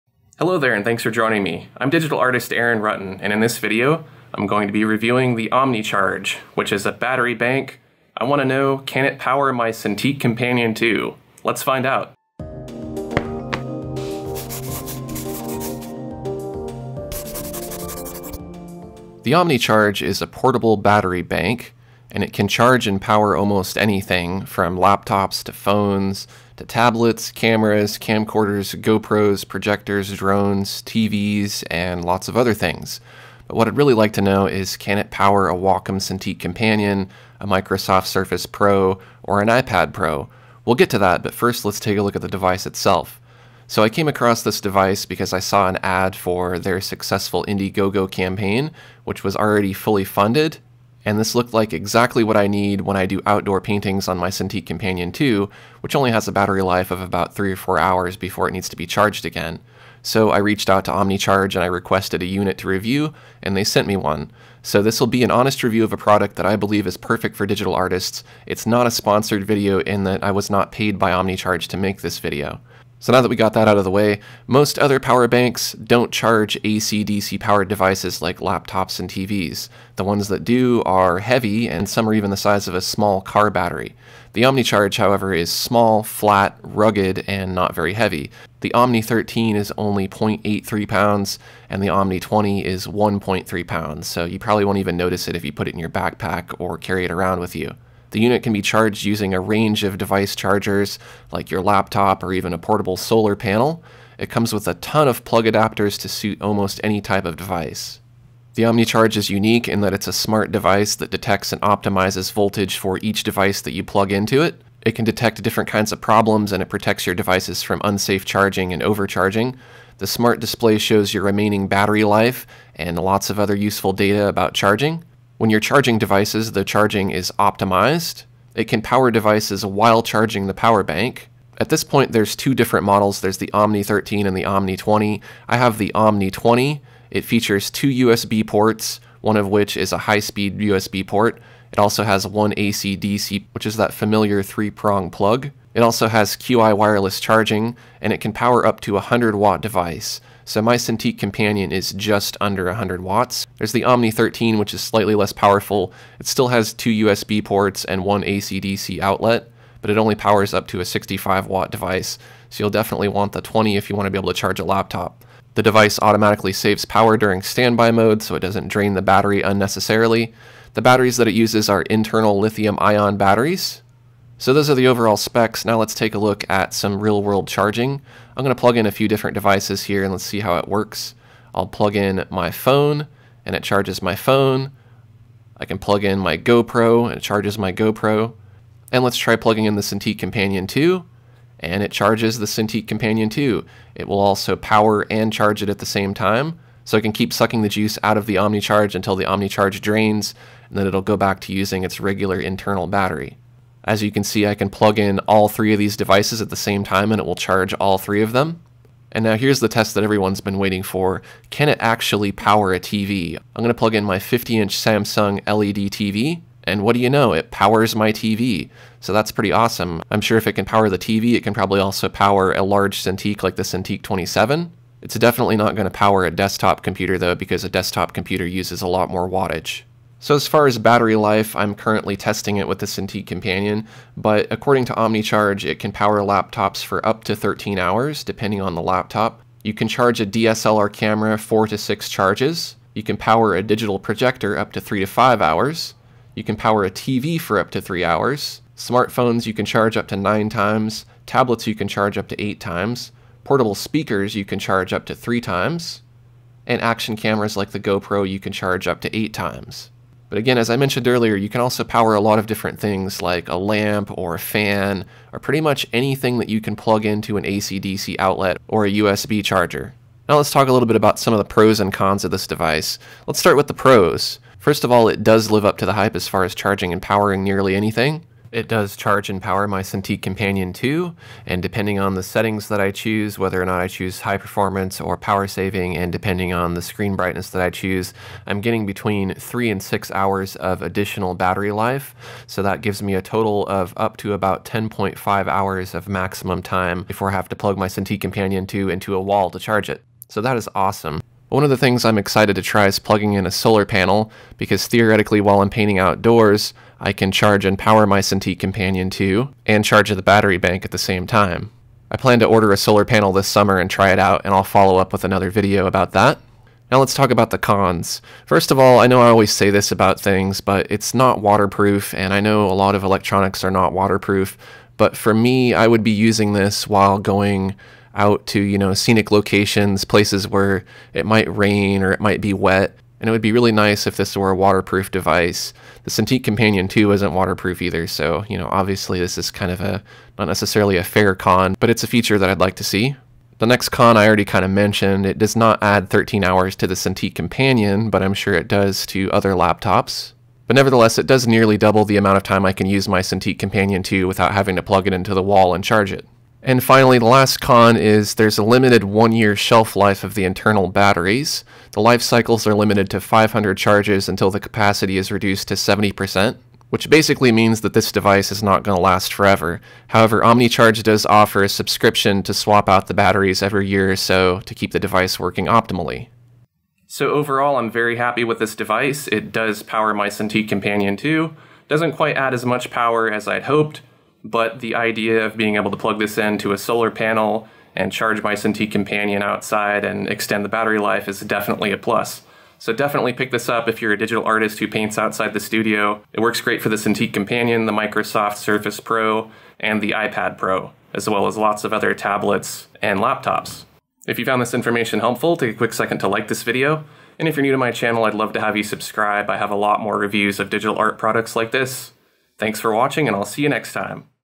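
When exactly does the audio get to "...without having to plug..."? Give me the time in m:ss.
5:54.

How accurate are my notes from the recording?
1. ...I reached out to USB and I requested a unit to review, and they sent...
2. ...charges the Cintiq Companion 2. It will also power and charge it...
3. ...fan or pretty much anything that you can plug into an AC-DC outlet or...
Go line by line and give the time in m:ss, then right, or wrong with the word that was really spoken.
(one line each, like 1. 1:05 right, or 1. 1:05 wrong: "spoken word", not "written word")
1. 1:00 wrong: "OmniCharge", not "USB"
2. 3:11 right
3. 4:24 right.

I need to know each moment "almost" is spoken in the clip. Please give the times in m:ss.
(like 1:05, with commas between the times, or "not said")
0:23, 1:46.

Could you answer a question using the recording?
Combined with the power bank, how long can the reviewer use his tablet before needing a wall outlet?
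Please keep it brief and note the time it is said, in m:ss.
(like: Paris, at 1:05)
10.5 hours, at 4:54.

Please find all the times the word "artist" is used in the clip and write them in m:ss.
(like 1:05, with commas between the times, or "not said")
0:02, 1:07, 6:34.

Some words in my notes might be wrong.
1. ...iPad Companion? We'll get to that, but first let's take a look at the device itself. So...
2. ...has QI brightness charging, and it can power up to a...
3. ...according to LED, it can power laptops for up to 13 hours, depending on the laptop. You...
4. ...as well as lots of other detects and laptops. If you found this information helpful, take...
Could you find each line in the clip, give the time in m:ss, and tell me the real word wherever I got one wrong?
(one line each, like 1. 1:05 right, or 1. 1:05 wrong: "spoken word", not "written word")
1. 0:39 wrong: "Pro", not "Companion"
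2. 2:26 wrong: "wireless", not "brightness"
3. 3:54 wrong: "OmniCharge", not "LED"
4. 6:41 wrong: "tablets", not "detects".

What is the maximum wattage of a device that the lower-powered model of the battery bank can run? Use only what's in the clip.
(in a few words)
65 watts.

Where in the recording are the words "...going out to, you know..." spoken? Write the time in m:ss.
5:27.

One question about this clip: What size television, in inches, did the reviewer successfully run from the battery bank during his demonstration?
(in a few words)
50 inch.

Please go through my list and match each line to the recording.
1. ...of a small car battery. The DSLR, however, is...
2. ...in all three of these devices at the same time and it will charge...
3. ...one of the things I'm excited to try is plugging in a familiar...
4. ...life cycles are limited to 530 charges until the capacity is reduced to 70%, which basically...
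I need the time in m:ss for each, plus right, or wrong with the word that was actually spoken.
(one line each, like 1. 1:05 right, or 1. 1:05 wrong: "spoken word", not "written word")
1. 1:22 wrong: "OmniCharge", not "DSLR"
2. 3:24 right
3. 5:01 wrong: "solar", not "familiar"
4. 6:02 wrong: "500", not "530".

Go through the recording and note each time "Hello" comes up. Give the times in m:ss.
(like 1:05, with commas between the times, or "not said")
0:00.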